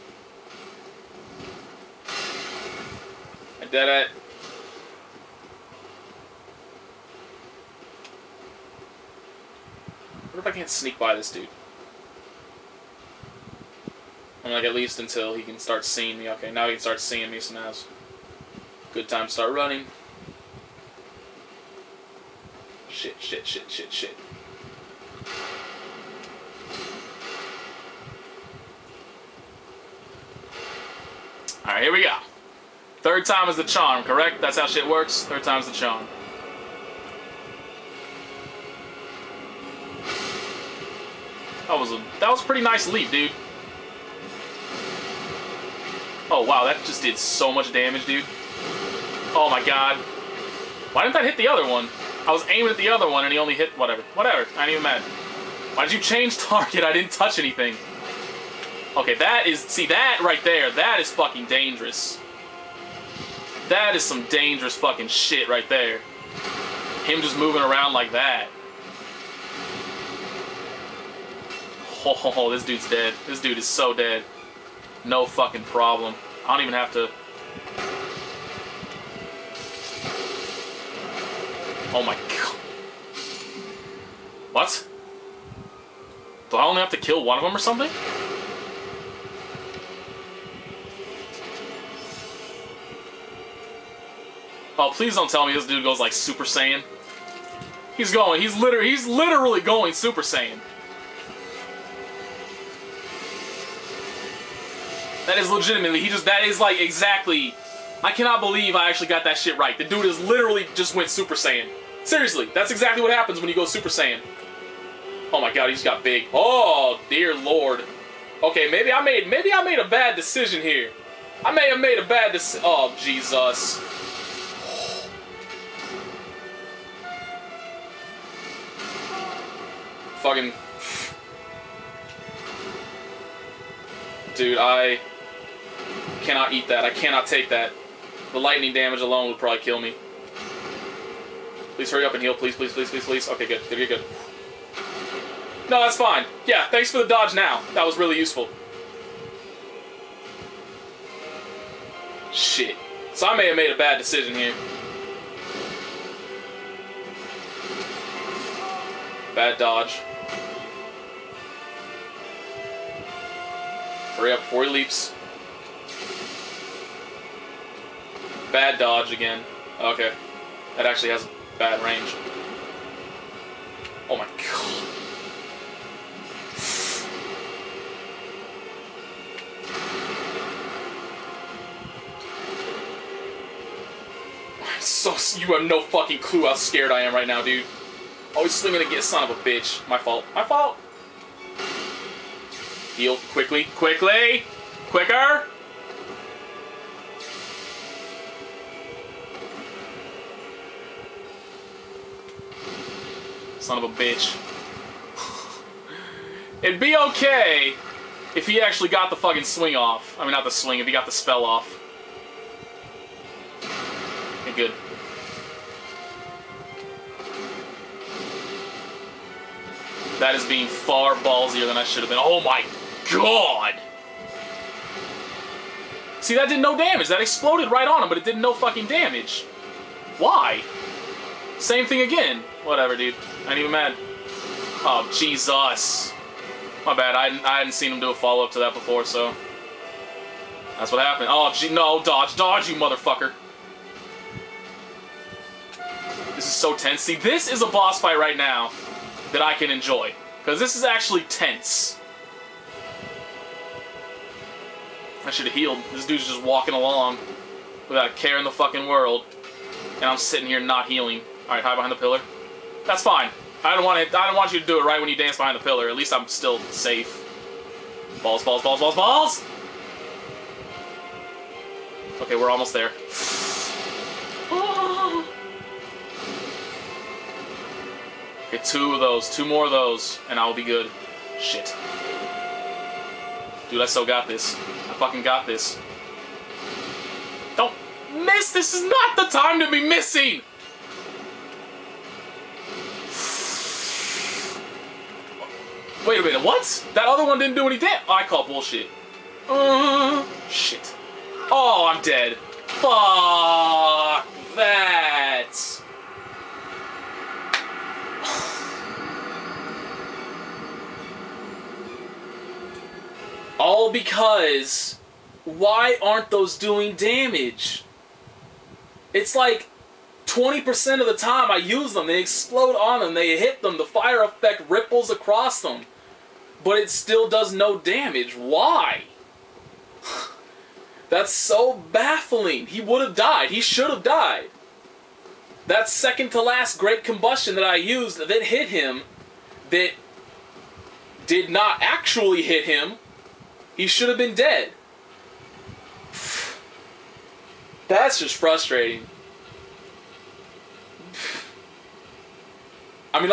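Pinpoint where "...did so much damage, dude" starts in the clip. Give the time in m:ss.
0:47.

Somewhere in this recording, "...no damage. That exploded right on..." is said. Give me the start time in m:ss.
3:46.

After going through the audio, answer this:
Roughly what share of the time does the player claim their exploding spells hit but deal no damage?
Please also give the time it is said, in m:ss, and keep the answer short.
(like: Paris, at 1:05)
20%, at 5:20.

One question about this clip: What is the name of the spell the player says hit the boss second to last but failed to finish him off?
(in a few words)
Great combustion.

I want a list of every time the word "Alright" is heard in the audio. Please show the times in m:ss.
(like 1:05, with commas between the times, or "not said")
0:31, 4:21.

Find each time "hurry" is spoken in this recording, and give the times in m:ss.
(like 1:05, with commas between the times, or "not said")
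2:21, 2:44.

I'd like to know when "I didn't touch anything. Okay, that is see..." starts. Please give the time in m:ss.
0:56.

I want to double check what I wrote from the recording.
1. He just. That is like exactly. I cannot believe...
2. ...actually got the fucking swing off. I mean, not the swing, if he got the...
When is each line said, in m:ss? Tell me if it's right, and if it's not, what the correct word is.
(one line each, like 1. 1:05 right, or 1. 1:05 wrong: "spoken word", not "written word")
1. 1:45 right
2. 3:28 right.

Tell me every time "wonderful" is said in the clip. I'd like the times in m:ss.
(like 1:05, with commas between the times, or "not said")
not said.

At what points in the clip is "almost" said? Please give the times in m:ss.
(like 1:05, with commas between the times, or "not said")
4:32.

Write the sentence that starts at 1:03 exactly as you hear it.
That is some dangerous fucking shit right there.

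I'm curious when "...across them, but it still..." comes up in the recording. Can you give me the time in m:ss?
5:25.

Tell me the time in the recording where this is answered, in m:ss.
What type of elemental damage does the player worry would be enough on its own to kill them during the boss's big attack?
2:18.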